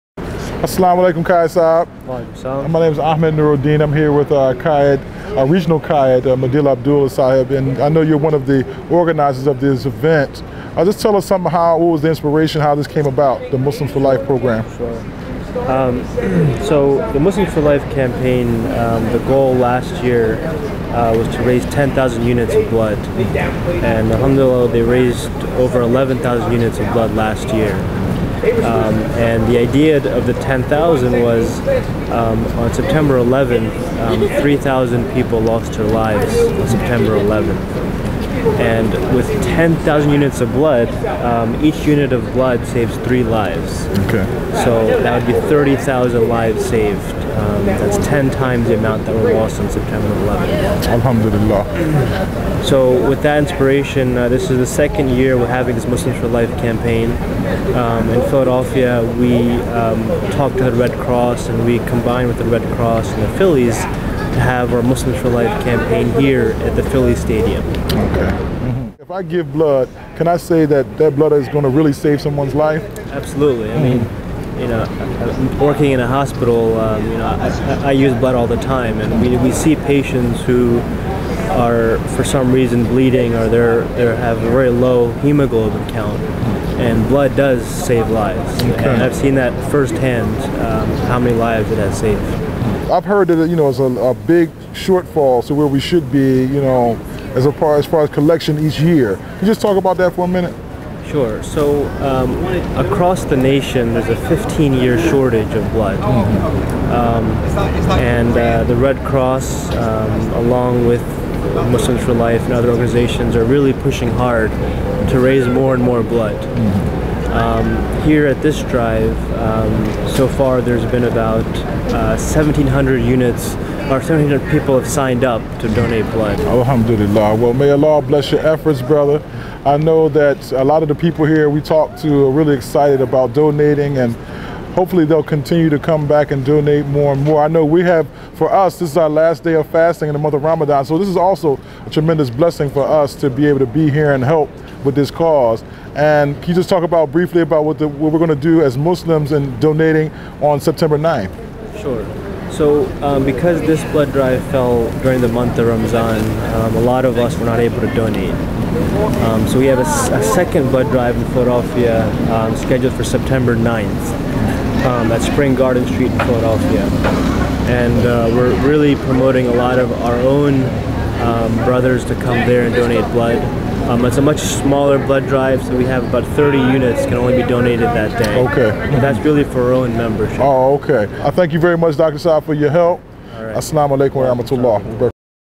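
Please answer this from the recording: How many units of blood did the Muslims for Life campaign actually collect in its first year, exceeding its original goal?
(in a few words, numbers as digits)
over 11,000.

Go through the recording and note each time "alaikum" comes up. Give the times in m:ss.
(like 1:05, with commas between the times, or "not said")
0:01, 3:03.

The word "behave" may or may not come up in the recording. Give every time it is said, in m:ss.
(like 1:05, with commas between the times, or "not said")
not said.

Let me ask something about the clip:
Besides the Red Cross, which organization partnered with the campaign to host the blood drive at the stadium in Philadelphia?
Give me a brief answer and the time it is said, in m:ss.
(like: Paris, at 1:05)
the Phillies, at 1:03.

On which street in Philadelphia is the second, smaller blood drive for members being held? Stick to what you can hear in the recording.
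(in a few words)
Spring Garden Street.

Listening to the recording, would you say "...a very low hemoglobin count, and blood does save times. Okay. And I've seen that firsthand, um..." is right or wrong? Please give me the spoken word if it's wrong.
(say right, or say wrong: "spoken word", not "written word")
wrong: "lives", not "times".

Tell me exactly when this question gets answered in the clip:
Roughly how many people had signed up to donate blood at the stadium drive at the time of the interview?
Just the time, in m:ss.
2:03.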